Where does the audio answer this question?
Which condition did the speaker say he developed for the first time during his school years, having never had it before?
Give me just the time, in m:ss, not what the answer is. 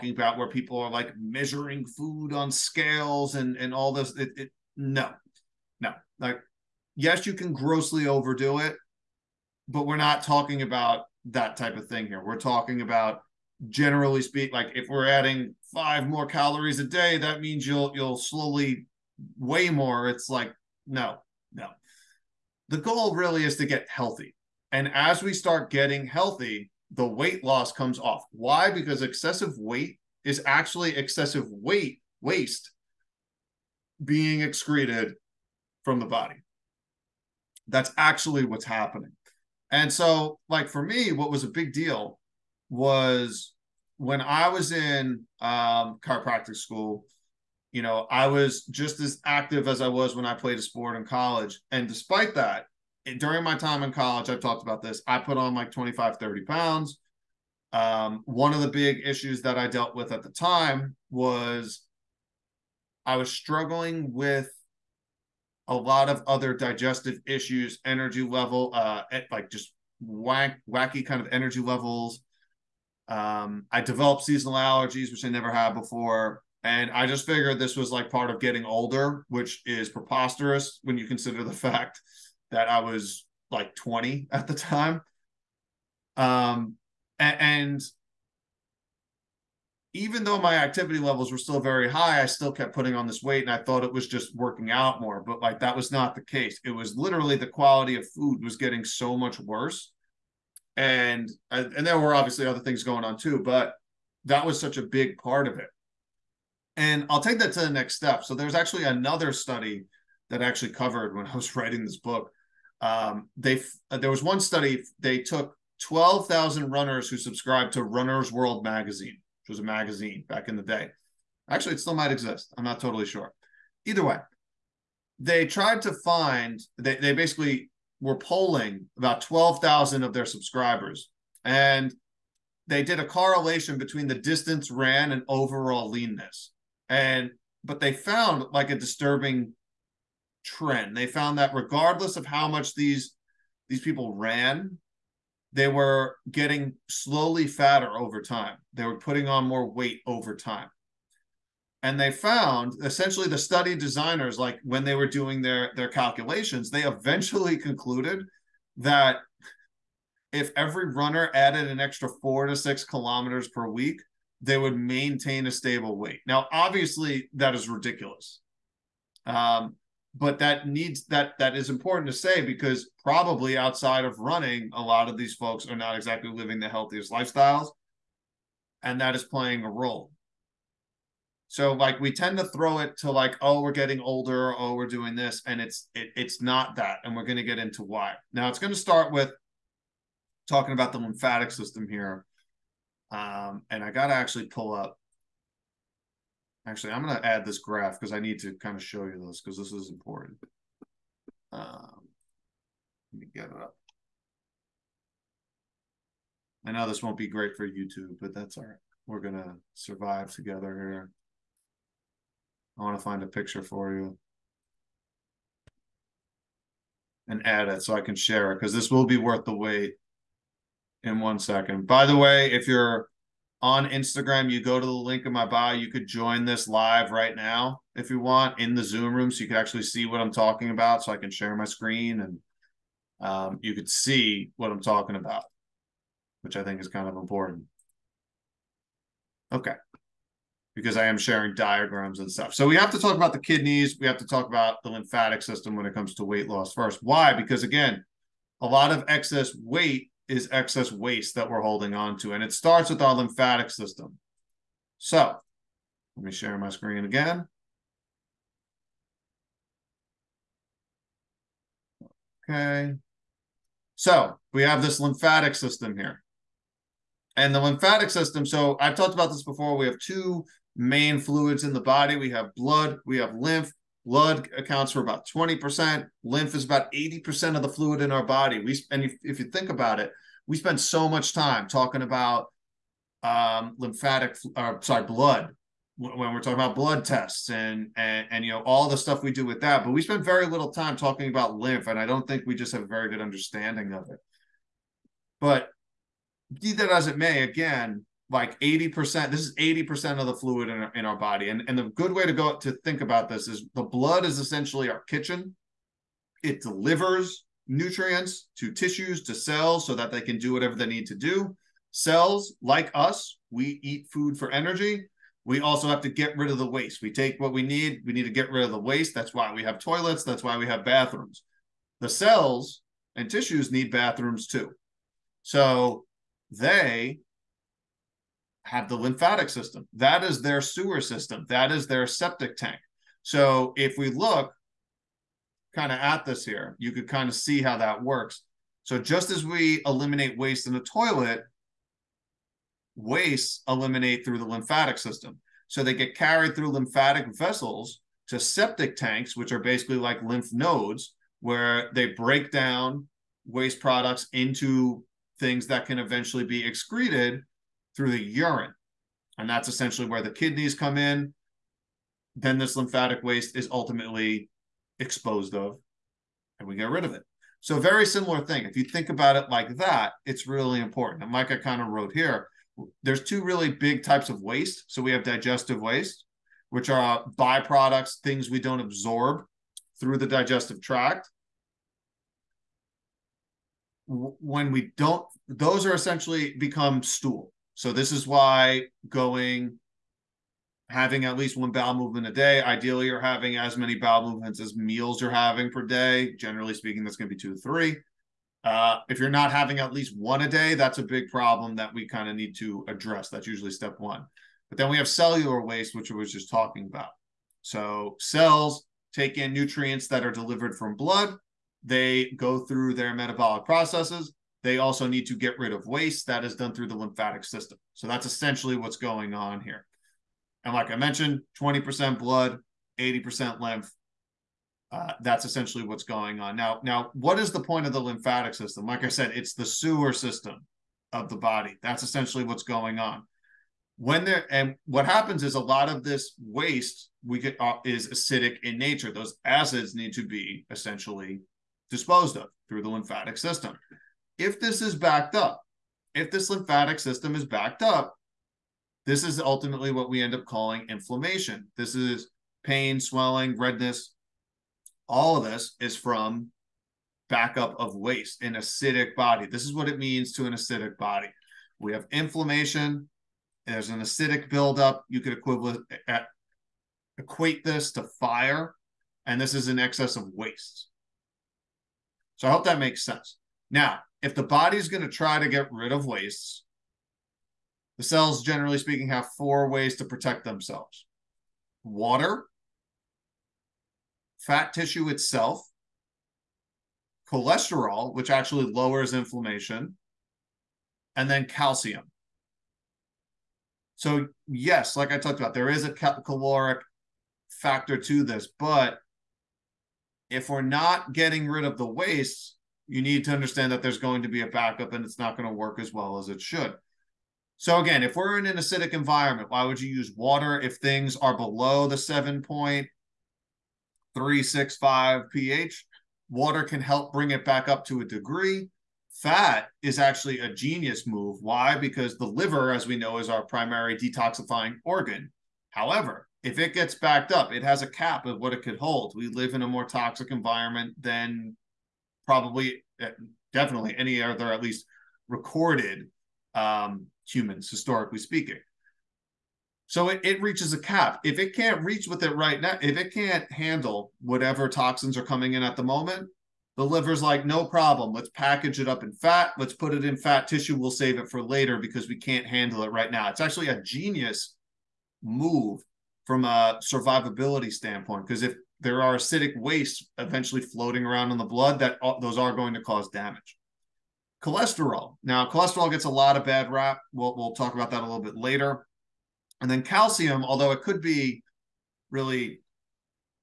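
1:14.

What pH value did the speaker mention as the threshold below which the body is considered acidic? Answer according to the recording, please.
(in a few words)
7.365.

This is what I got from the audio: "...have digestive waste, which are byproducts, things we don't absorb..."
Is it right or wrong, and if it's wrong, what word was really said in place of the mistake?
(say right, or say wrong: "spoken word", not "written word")
right.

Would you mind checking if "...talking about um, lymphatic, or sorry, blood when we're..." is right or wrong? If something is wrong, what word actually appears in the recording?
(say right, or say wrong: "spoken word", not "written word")
right.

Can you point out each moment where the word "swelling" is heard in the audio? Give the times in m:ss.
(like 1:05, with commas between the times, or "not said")
7:32.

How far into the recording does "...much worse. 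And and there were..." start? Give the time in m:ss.
1:39.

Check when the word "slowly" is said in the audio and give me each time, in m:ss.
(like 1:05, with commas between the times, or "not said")
0:18, 2:26.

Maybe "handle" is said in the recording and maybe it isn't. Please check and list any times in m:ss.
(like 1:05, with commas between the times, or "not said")
9:03, 9:12.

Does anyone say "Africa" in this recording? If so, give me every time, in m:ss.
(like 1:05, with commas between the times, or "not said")
not said.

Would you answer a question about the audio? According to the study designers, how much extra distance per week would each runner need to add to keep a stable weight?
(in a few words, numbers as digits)
4 to 6 kilometers.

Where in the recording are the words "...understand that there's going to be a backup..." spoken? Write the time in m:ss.
8:23.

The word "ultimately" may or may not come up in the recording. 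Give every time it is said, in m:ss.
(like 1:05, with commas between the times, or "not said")
6:03, 7:29.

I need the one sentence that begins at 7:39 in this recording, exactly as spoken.
This is what it means to an acidic body.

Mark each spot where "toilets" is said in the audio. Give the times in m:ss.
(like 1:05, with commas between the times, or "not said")
5:19, 5:40.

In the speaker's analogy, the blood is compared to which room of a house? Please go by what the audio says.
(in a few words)
Kitchen.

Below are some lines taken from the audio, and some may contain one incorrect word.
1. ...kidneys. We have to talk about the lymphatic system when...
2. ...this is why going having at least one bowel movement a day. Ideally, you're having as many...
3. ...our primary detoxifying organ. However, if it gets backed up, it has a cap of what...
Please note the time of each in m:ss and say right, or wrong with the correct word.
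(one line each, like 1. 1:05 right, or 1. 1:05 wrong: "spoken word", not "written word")
1. 4:03 right
2. 6:27 right
3. 8:43 right.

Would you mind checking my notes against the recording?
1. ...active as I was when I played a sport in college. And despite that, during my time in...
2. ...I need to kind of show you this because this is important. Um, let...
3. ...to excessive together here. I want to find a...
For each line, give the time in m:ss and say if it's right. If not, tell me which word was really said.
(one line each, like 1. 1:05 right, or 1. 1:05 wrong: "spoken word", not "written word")
1. 0:49 right
2. 3:18 right
3. 3:29 wrong: "survive", not "excessive".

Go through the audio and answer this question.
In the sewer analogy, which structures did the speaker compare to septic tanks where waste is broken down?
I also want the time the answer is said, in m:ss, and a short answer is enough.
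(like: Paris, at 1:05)
Lymph nodes, at 5:50.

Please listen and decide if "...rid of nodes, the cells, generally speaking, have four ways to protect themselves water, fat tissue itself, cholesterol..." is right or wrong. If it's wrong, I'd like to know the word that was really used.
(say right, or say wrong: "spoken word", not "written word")
wrong: "wastes", not "nodes".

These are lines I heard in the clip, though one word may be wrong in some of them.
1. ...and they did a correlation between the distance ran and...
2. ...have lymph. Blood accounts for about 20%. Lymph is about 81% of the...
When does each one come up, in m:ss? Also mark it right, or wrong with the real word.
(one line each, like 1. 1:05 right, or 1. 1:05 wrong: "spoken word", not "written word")
1. 2:11 right
2. 4:33 wrong: "80", not "81".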